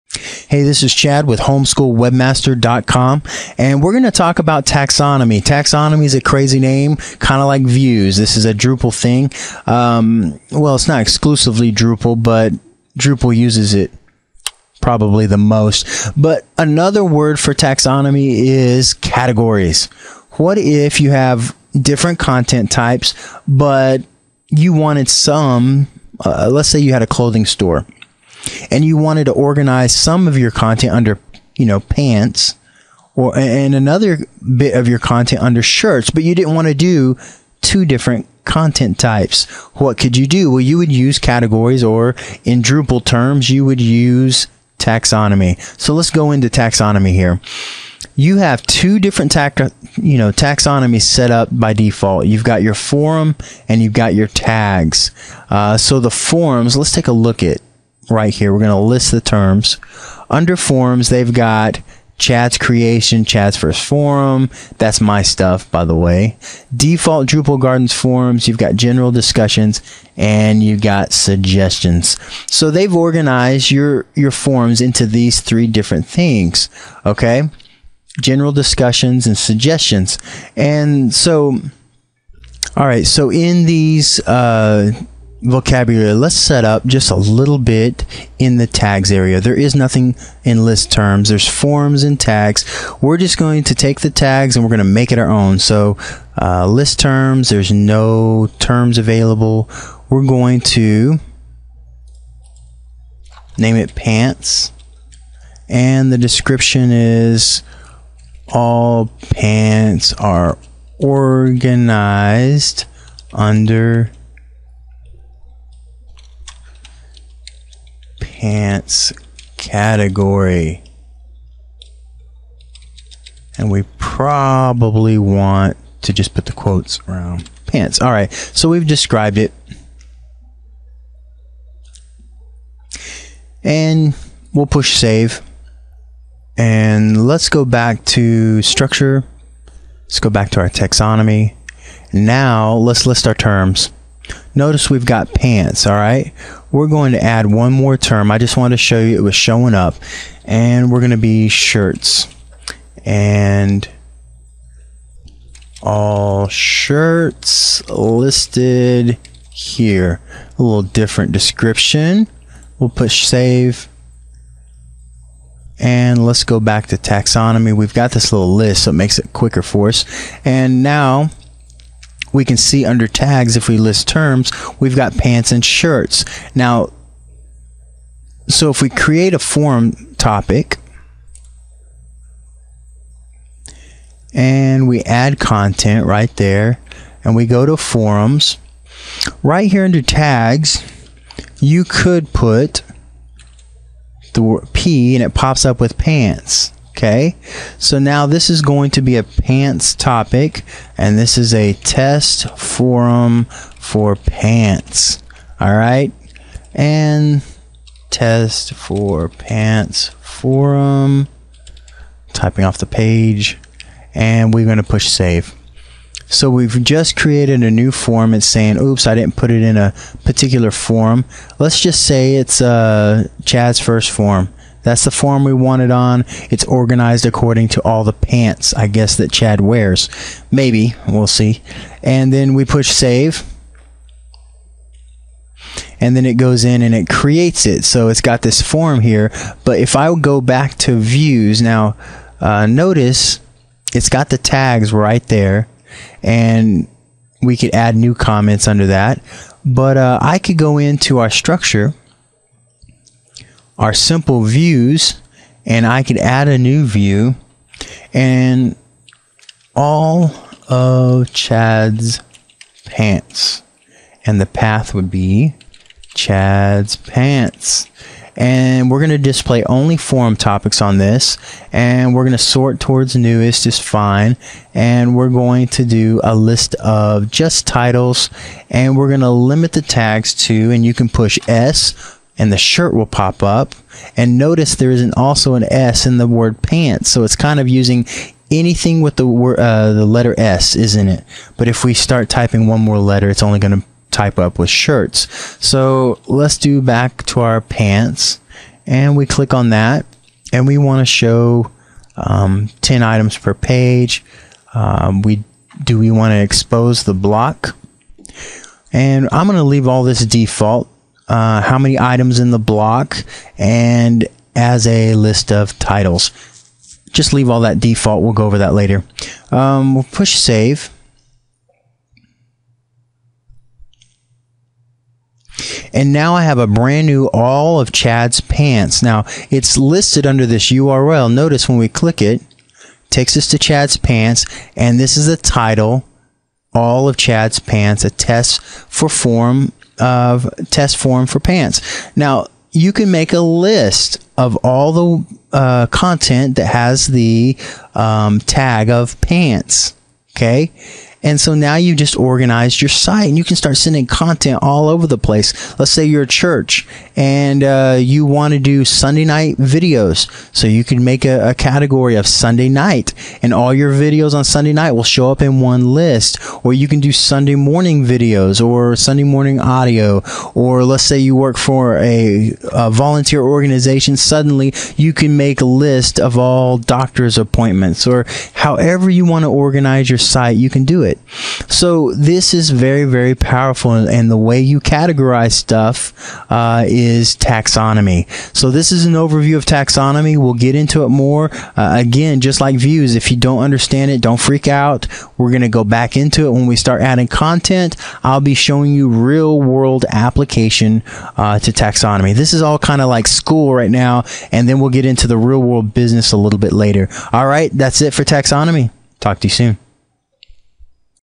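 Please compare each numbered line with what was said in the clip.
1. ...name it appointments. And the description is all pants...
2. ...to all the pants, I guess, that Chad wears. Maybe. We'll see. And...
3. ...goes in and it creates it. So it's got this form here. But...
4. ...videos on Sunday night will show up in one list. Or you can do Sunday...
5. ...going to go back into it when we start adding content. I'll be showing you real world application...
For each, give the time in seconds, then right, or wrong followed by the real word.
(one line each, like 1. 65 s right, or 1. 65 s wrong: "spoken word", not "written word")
1. 103 s wrong: "pants", not "appointments"
2. 227 s right
3. 236 s right
4. 363 s right
5. 395 s right.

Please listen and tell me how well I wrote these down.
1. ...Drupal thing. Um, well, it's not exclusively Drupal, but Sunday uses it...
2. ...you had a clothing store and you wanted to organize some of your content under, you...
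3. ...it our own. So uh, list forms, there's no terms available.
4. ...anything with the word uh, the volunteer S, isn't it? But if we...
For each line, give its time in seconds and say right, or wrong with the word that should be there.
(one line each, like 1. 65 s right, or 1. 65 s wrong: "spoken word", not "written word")
1. 8 s wrong: "Drupal", not "Sunday"
2. 26 s right
3. 95 s wrong: "terms", not "forms"
4. 288 s wrong: "letter", not "volunteer".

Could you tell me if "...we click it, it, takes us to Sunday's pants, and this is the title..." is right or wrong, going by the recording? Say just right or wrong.
wrong.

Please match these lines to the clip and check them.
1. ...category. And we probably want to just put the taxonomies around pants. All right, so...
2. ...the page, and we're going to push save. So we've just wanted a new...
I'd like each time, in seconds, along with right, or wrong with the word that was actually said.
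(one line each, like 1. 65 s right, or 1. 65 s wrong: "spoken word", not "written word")
1. 119 s wrong: "quotes", not "taxonomies"
2. 212 s wrong: "created", not "wanted".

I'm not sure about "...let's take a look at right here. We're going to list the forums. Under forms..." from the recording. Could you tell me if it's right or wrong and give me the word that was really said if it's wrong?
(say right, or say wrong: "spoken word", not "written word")
wrong: "terms", not "forums".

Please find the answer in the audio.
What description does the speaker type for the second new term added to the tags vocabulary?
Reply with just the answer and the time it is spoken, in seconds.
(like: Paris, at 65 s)
All shirts listed here, at 155 s.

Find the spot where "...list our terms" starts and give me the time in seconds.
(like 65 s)
143 s.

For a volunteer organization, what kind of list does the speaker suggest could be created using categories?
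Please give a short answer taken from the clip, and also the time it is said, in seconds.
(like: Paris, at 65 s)
Doctor's appointments, at 376 s.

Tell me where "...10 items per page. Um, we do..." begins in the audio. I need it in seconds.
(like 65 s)
302 s.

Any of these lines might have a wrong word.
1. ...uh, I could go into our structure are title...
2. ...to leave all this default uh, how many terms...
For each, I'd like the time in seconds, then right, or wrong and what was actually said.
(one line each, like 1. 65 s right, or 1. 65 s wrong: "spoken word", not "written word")
1. 249 s wrong: "simple", not "title"
2. 309 s wrong: "items", not "terms".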